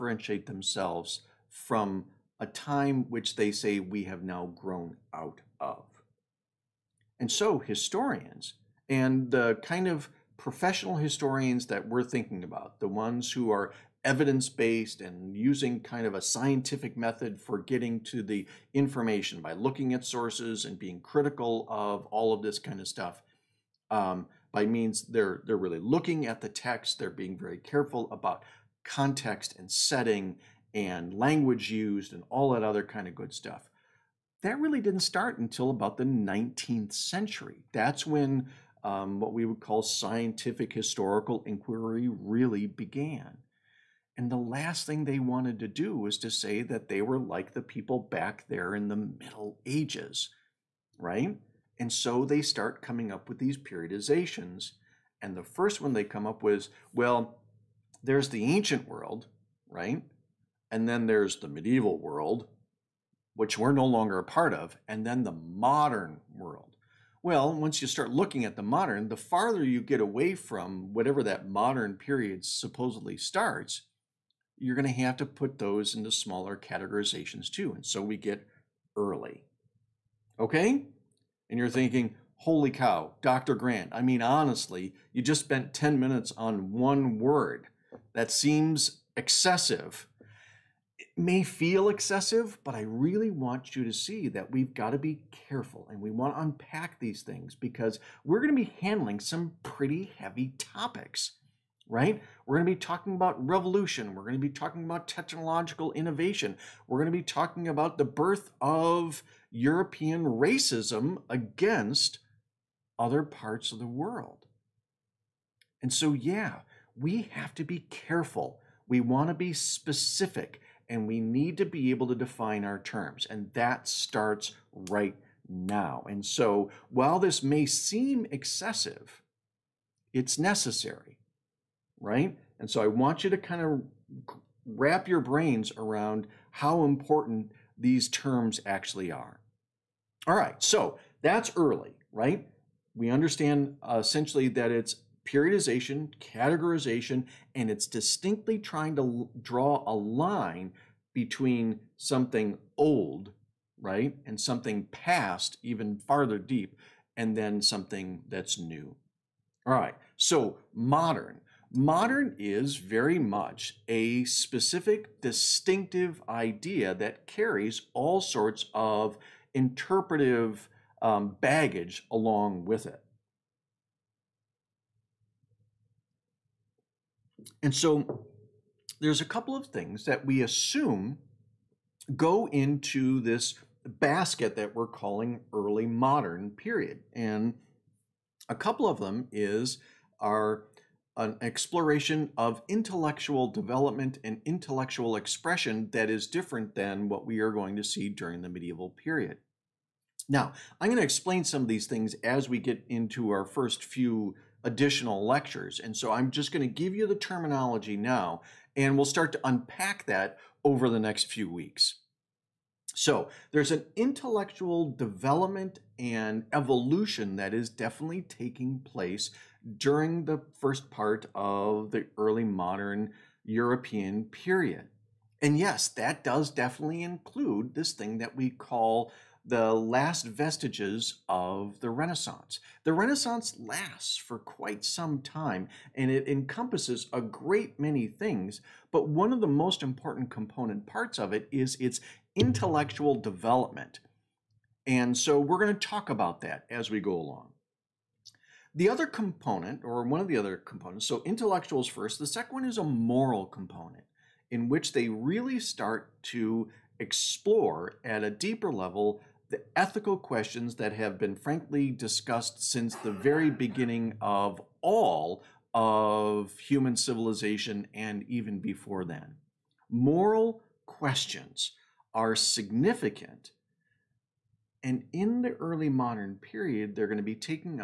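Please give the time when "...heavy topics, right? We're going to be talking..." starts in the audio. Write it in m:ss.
1:40.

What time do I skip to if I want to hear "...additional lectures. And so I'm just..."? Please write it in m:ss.
3:24.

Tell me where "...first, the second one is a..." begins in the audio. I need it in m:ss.
4:11.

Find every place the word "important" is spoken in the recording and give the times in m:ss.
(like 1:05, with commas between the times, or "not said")
2:16, 3:59.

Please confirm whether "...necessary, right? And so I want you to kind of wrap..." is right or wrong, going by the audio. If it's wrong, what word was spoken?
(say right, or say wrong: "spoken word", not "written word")
right.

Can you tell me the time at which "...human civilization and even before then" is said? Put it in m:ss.
4:26.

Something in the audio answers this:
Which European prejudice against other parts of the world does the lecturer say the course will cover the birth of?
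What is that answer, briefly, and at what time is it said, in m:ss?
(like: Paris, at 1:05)
Racism, at 1:50.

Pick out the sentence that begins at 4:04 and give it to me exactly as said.
And so we're going to talk about that as we go along.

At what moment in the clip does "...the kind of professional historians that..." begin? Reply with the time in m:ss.
0:09.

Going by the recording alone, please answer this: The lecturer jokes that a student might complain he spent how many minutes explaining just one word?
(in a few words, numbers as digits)
10.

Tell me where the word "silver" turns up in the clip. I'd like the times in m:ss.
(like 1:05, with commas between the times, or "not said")
not said.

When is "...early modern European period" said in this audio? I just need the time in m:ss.
3:42.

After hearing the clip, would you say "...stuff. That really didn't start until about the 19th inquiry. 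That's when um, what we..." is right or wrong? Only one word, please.
wrong.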